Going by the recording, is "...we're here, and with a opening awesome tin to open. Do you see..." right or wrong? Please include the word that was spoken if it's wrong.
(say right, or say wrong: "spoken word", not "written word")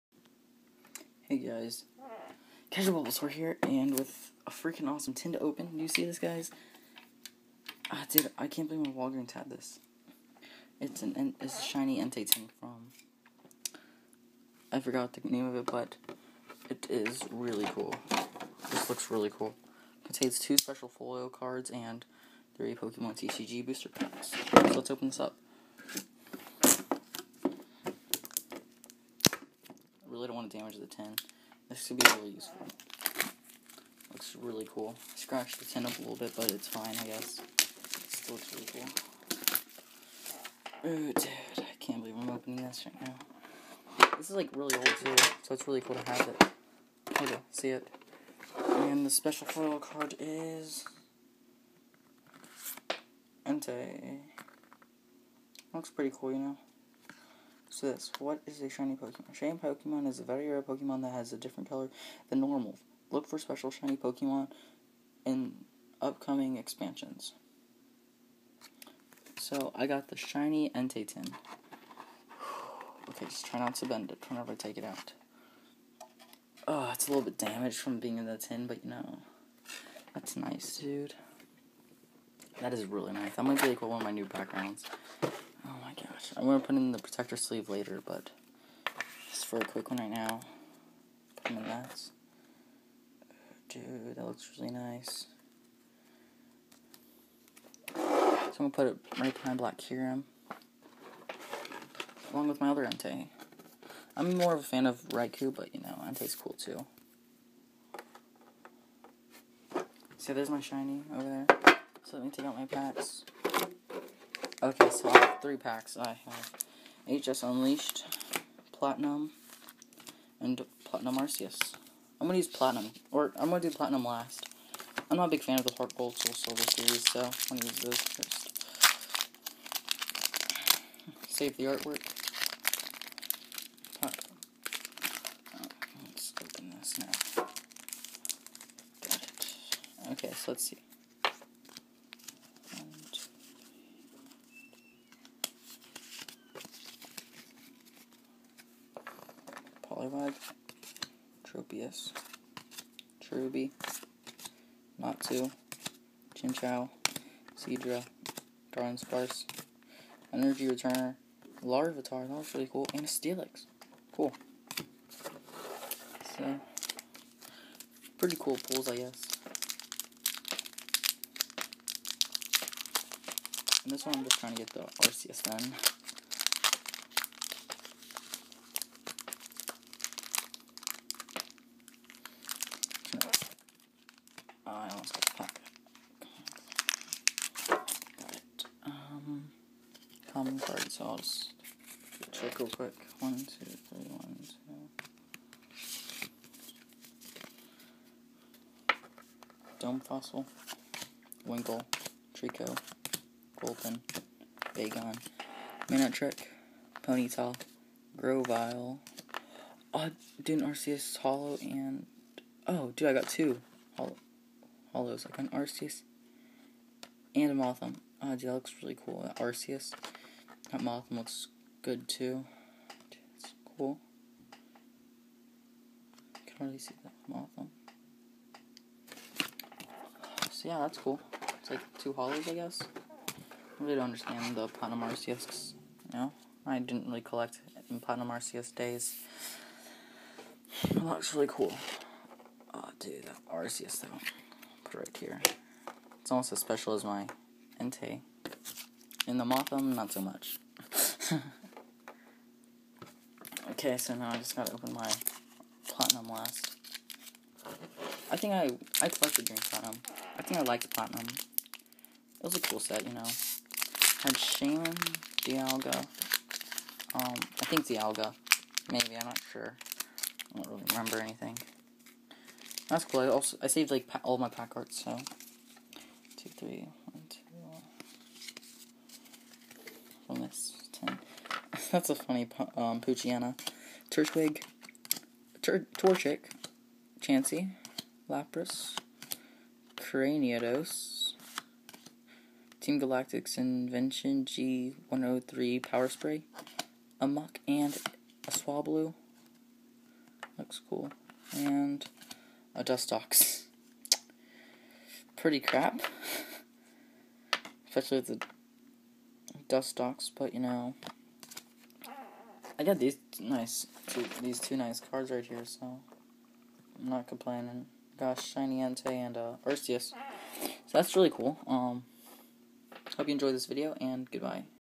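wrong: "freaking", not "opening".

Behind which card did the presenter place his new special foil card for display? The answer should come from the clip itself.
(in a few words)
Black Kyurem.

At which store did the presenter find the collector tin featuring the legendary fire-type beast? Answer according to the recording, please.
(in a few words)
Walgreens.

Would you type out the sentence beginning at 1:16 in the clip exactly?
Oh, it's a little bit damaged from being in the tin, but you know, that's nice, dude.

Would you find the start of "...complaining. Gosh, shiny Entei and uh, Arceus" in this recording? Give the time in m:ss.
5:17.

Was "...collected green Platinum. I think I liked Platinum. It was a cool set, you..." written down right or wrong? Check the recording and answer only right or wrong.
right.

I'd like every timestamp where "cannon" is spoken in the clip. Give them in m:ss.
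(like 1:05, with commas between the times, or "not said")
not said.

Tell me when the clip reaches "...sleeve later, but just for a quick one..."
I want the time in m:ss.
1:27.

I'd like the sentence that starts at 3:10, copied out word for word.
so I'll just check real quick.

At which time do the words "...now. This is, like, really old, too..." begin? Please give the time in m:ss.
0:43.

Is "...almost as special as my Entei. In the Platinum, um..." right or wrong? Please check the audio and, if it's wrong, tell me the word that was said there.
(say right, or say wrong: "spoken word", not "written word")
wrong: "Mothim", not "Platinum".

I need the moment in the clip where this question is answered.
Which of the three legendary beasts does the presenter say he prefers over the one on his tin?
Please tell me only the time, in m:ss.
1:45.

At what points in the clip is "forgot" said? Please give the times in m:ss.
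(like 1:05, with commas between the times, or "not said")
0:14.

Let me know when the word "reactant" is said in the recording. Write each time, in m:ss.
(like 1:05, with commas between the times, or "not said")
not said.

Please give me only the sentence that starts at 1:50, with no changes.
See, there's my shiny over there.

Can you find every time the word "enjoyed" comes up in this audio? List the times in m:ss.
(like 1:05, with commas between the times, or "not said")
5:23.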